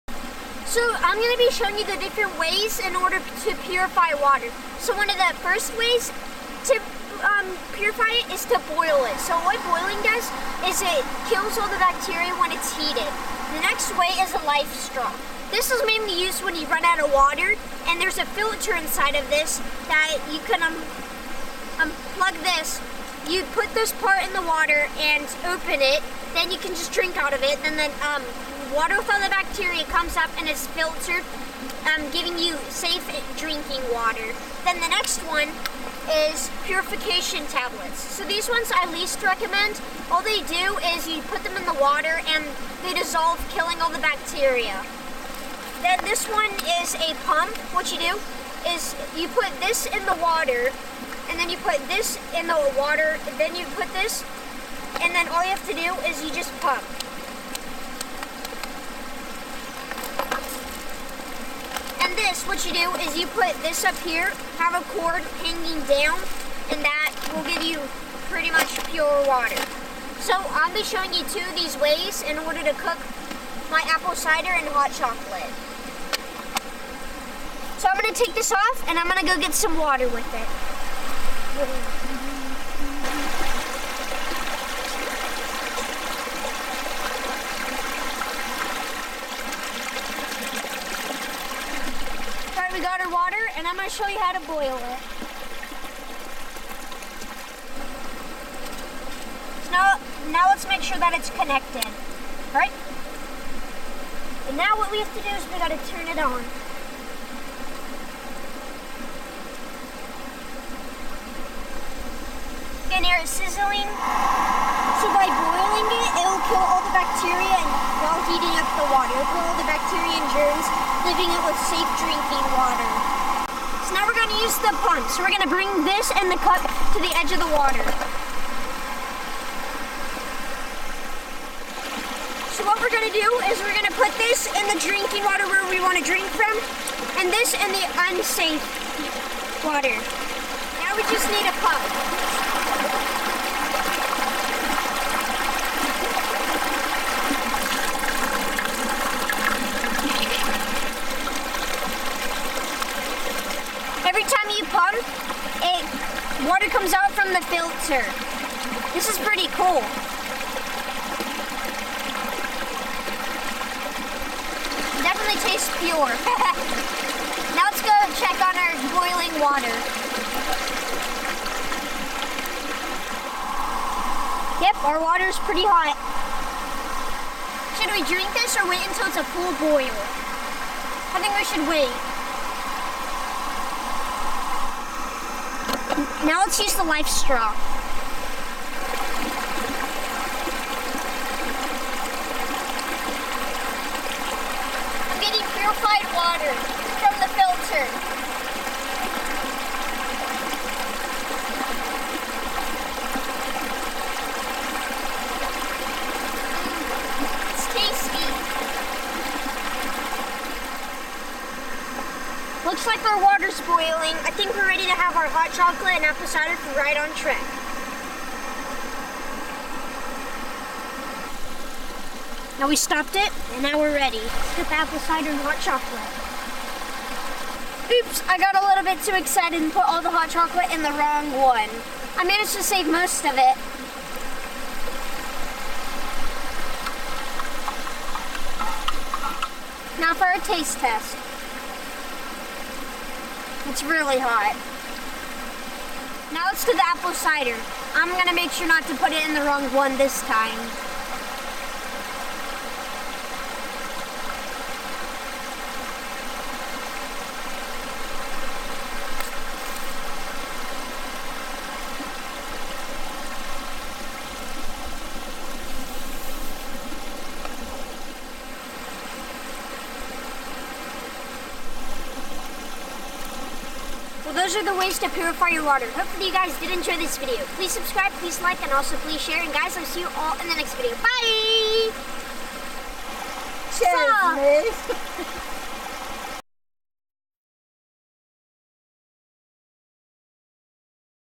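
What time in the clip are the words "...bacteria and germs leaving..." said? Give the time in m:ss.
1:59.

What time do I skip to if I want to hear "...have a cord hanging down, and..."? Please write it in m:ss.
1:04.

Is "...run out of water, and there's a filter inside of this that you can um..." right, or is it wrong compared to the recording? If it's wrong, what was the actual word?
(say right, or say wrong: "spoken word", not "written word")
right.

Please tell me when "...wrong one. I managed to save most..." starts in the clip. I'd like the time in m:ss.
3:50.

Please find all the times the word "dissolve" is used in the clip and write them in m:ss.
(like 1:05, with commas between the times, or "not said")
0:42.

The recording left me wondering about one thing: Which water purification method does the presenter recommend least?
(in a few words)
Purification tablets.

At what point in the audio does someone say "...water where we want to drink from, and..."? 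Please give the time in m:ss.
2:15.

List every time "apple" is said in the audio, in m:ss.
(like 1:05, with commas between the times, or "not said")
1:13, 3:36, 3:44, 4:06.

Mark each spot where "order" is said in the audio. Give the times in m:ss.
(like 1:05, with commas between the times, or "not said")
0:02, 1:12.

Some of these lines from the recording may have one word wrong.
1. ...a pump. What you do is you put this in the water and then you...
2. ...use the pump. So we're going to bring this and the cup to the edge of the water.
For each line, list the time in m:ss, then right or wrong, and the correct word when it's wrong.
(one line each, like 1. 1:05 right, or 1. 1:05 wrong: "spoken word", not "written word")
1. 0:46 right
2. 2:04 right.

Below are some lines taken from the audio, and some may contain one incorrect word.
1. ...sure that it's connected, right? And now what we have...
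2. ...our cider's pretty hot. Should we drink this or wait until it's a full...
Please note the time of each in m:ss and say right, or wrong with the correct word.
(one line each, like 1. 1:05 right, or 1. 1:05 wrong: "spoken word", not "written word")
1. 1:40 right
2. 2:54 wrong: "water", not "cider".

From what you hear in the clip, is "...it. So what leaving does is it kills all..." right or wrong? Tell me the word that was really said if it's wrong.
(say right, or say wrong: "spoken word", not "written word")
wrong: "boiling", not "leaving".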